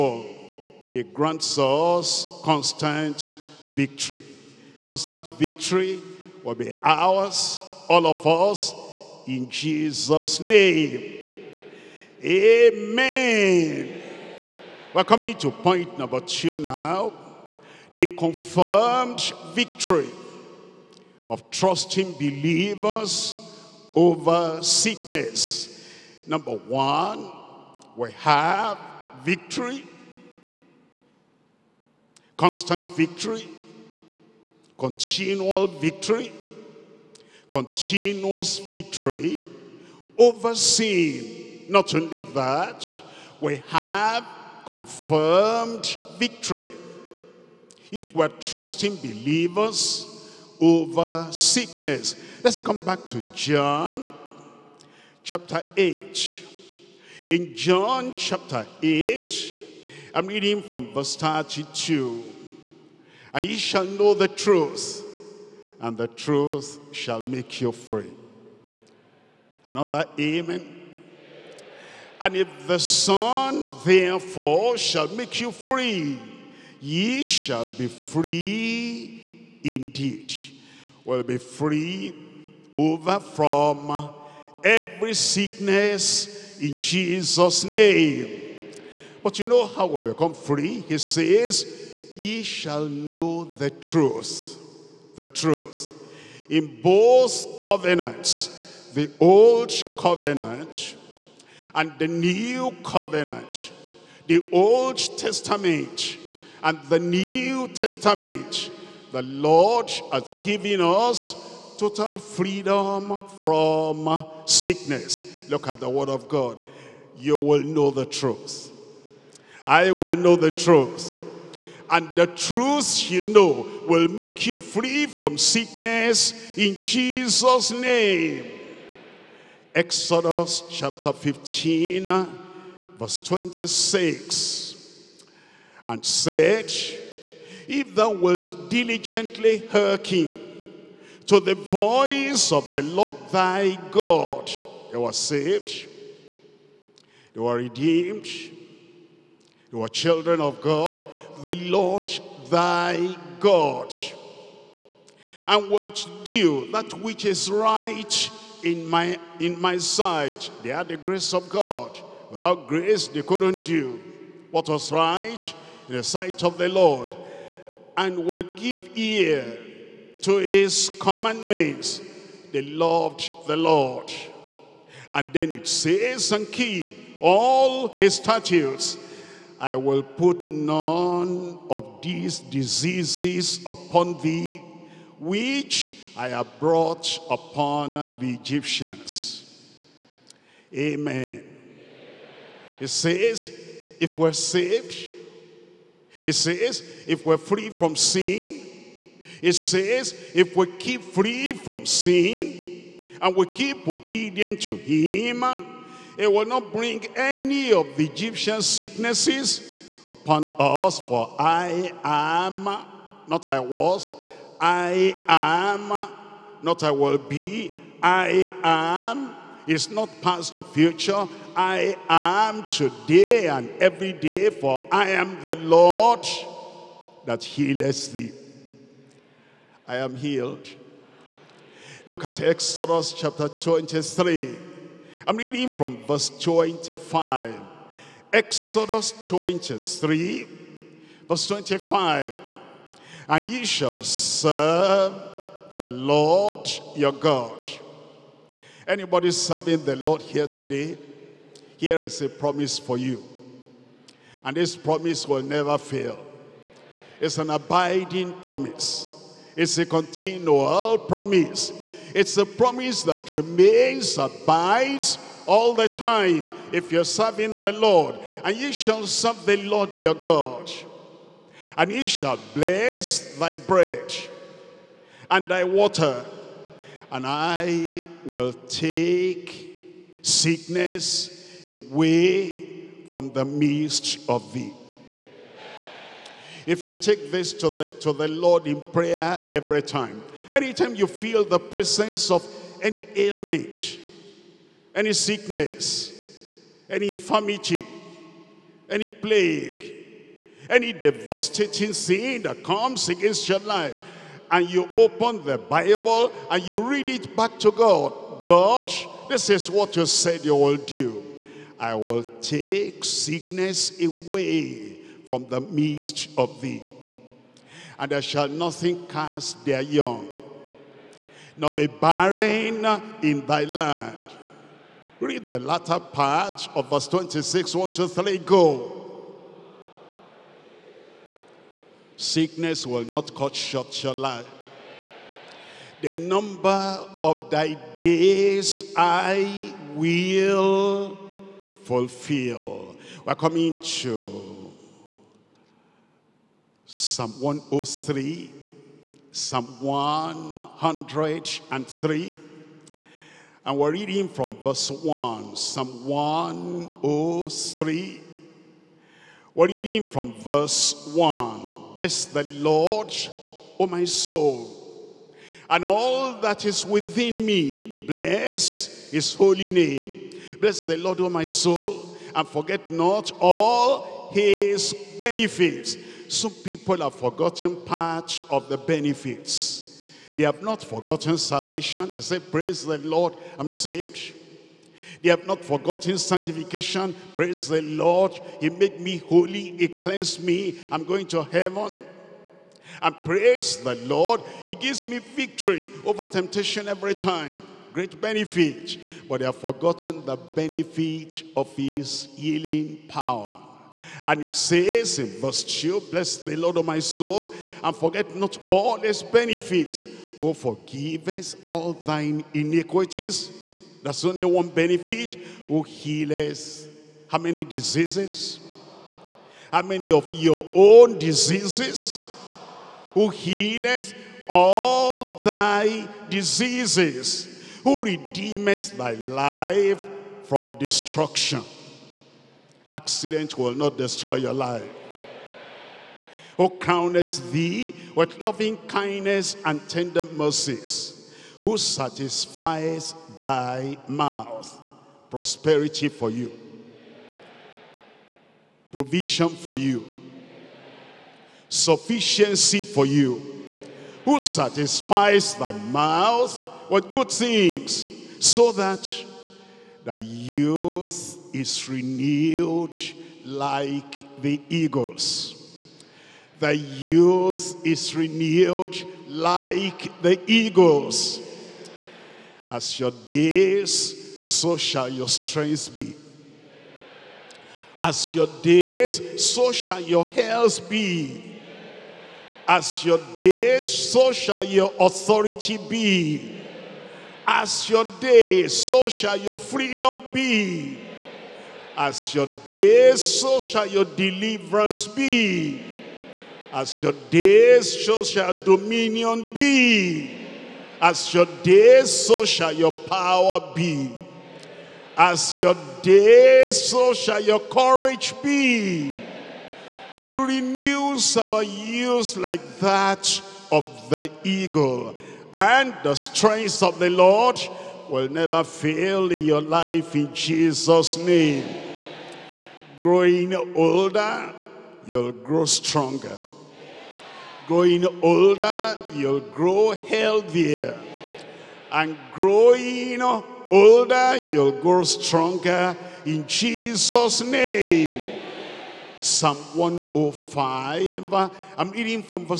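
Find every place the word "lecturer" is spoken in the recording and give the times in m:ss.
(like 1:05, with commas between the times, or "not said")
not said.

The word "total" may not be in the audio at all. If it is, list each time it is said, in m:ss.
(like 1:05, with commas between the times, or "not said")
1:51.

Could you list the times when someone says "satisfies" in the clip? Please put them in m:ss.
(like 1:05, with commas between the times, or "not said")
7:21, 7:34.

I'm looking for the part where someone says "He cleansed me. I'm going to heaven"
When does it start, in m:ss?
6:29.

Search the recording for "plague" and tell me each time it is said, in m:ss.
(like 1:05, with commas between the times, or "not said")
4:59.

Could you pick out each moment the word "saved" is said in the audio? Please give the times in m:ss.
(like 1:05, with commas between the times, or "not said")
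2:25, 3:14, 6:23.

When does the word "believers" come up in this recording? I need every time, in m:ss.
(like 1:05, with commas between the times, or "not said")
0:22, 0:48.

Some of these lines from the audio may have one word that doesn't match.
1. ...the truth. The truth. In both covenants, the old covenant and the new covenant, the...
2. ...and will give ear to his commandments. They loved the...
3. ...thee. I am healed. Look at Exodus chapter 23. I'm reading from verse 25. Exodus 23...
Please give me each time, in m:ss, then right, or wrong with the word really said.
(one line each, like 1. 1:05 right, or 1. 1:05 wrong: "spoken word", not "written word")
1. 1:33 right
2. 2:48 right
3. 3:48 right.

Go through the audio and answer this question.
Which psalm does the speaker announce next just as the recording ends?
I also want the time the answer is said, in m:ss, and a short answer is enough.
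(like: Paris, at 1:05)
Psalm 105, at 8:59.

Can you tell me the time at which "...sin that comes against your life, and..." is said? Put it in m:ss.
5:01.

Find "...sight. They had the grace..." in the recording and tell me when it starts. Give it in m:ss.
2:39.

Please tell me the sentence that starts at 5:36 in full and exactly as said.
The number of thy days I will fulfill.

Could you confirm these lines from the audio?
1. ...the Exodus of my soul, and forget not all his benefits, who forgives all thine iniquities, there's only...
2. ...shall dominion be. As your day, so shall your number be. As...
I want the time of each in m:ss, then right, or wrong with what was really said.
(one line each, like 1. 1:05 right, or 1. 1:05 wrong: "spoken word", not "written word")
1. 6:46 wrong: "Lord", not "Exodus"
2. 8:18 wrong: "power", not "number".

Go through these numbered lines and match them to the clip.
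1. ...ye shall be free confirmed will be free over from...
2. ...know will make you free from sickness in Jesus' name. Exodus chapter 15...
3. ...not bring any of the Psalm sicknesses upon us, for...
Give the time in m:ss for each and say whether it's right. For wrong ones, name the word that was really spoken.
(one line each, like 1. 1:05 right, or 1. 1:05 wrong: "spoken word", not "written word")
1. 1:16 wrong: "indeed", not "confirmed"
2. 2:03 right
3. 3:26 wrong: "Egyptian", not "Psalm".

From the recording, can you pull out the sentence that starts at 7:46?
The youth is renewed like the eagles.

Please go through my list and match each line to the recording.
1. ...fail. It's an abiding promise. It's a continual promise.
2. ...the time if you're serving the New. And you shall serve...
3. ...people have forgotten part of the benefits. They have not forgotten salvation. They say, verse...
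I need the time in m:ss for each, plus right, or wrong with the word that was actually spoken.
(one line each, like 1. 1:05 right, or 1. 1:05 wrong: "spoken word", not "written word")
1. 4:15 right
2. 4:25 wrong: "Lord", not "New"
3. 6:16 wrong: "praise", not "verse".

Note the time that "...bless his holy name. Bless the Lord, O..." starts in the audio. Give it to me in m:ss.
6:08.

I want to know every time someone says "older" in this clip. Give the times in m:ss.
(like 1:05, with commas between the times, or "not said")
8:43, 8:48, 8:53.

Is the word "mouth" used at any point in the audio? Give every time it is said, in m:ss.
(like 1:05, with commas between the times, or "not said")
7:24, 7:35.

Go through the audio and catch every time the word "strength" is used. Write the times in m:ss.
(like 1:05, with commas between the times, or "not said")
7:55, 8:36.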